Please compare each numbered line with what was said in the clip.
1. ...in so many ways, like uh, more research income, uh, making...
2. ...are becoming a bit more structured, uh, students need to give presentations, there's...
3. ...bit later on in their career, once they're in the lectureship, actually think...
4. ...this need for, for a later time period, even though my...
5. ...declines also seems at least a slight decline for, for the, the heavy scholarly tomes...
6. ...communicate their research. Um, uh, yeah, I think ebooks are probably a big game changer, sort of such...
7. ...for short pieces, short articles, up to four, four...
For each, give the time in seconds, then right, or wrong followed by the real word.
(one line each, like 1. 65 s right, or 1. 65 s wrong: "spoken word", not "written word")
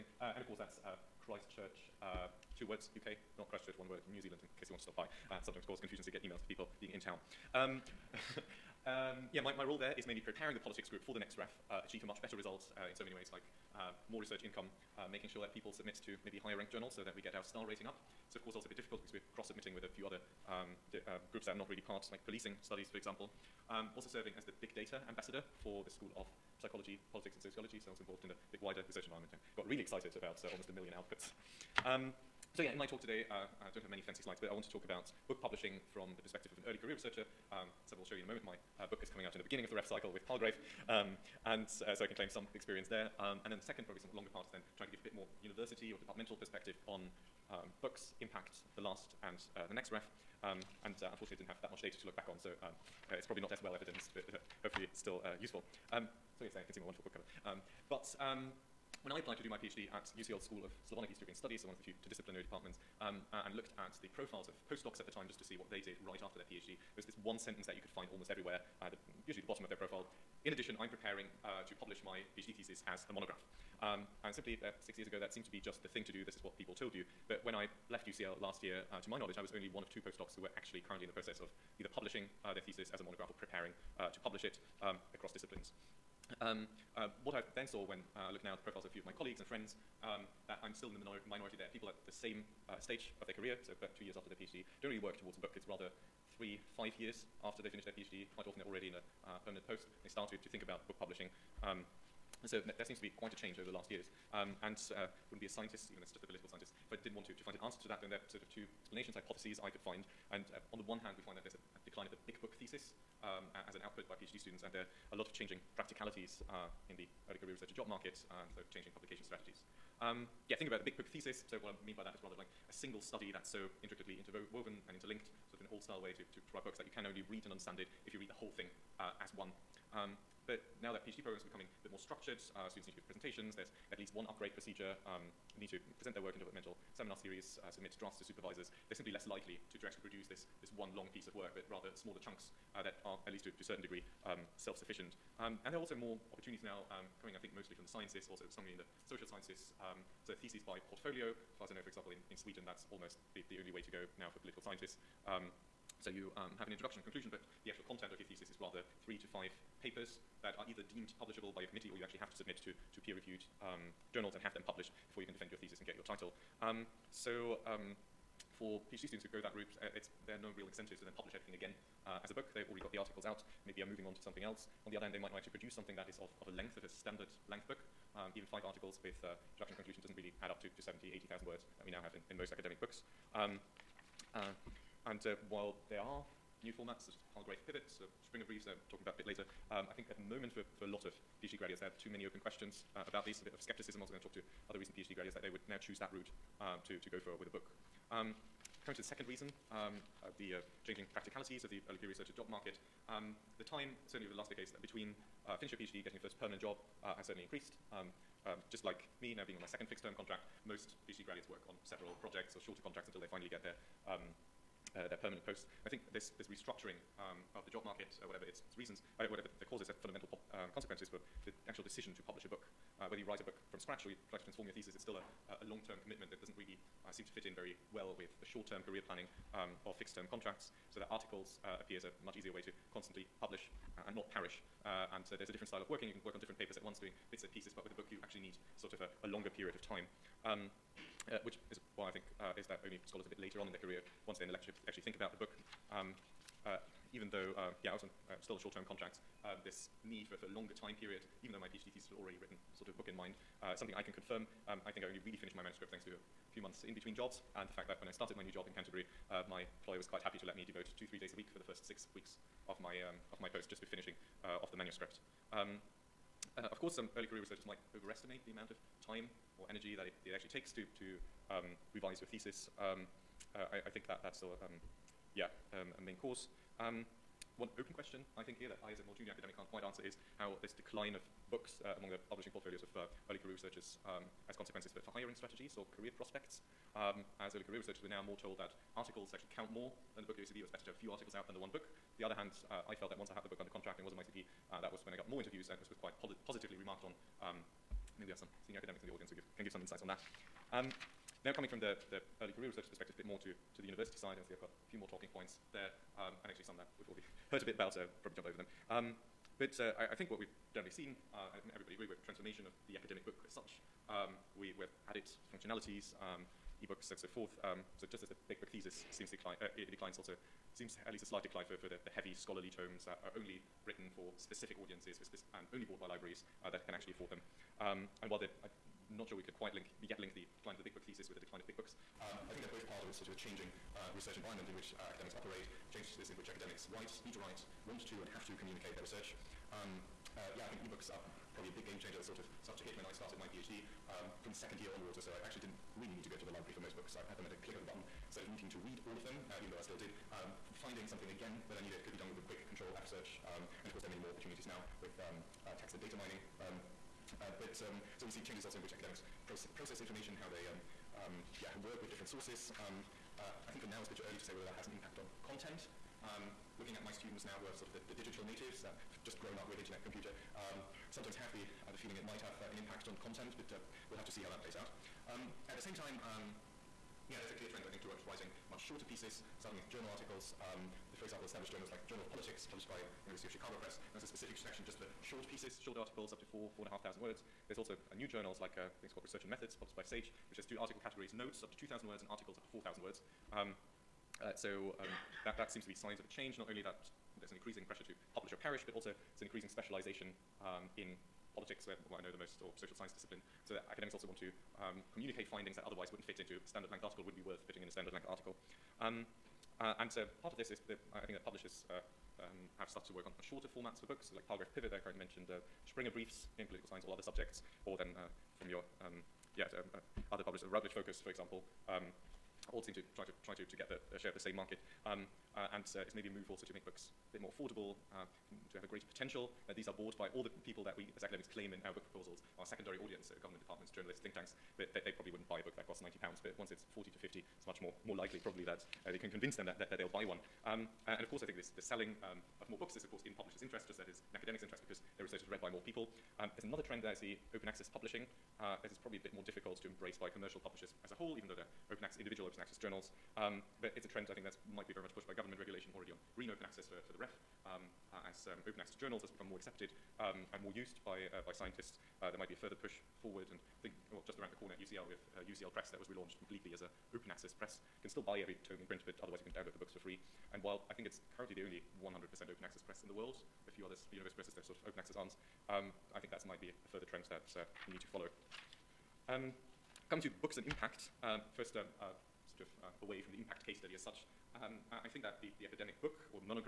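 1. 12 s right
2. 131 s right
3. 243 s right
4. 249 s wrong: "longer", not "later"
5. 319 s right
6. 338 s right
7. 384 s right.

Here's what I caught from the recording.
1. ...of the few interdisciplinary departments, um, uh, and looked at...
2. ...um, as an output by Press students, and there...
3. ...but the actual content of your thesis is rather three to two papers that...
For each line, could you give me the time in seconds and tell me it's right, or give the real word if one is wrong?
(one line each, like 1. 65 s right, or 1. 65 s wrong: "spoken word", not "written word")
1. 61 s right
2. 113 s wrong: "PhD", not "Press"
3. 157 s wrong: "five", not "two".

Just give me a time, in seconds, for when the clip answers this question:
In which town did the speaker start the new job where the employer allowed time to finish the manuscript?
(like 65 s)
258 s.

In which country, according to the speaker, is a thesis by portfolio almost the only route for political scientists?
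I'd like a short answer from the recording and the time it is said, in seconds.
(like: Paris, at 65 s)
Sweden, at 152 s.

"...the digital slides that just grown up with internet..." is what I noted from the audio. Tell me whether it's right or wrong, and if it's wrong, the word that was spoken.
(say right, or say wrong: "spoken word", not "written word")
wrong: "natives", not "slides".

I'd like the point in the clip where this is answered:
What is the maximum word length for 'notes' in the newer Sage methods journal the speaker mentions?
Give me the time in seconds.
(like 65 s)
391 s.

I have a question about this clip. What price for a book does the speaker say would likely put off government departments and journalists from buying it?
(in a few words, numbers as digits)
90 pounds.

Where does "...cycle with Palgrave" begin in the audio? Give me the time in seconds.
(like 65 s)
39 s.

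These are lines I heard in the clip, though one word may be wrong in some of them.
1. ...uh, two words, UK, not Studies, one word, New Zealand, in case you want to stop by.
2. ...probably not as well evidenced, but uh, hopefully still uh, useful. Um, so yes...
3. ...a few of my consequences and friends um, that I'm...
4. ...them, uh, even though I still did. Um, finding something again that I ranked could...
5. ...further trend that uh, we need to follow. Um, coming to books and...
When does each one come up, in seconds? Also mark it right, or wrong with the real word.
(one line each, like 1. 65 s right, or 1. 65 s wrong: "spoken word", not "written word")
1. 2 s wrong: "Christchurch", not "Studies"
2. 53 s right
3. 88 s wrong: "colleagues", not "consequences"
4. 349 s wrong: "needed", not "ranked"
5. 476 s right.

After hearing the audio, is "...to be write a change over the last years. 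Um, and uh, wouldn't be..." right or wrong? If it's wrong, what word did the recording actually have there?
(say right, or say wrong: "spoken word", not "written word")
wrong: "quite", not "write".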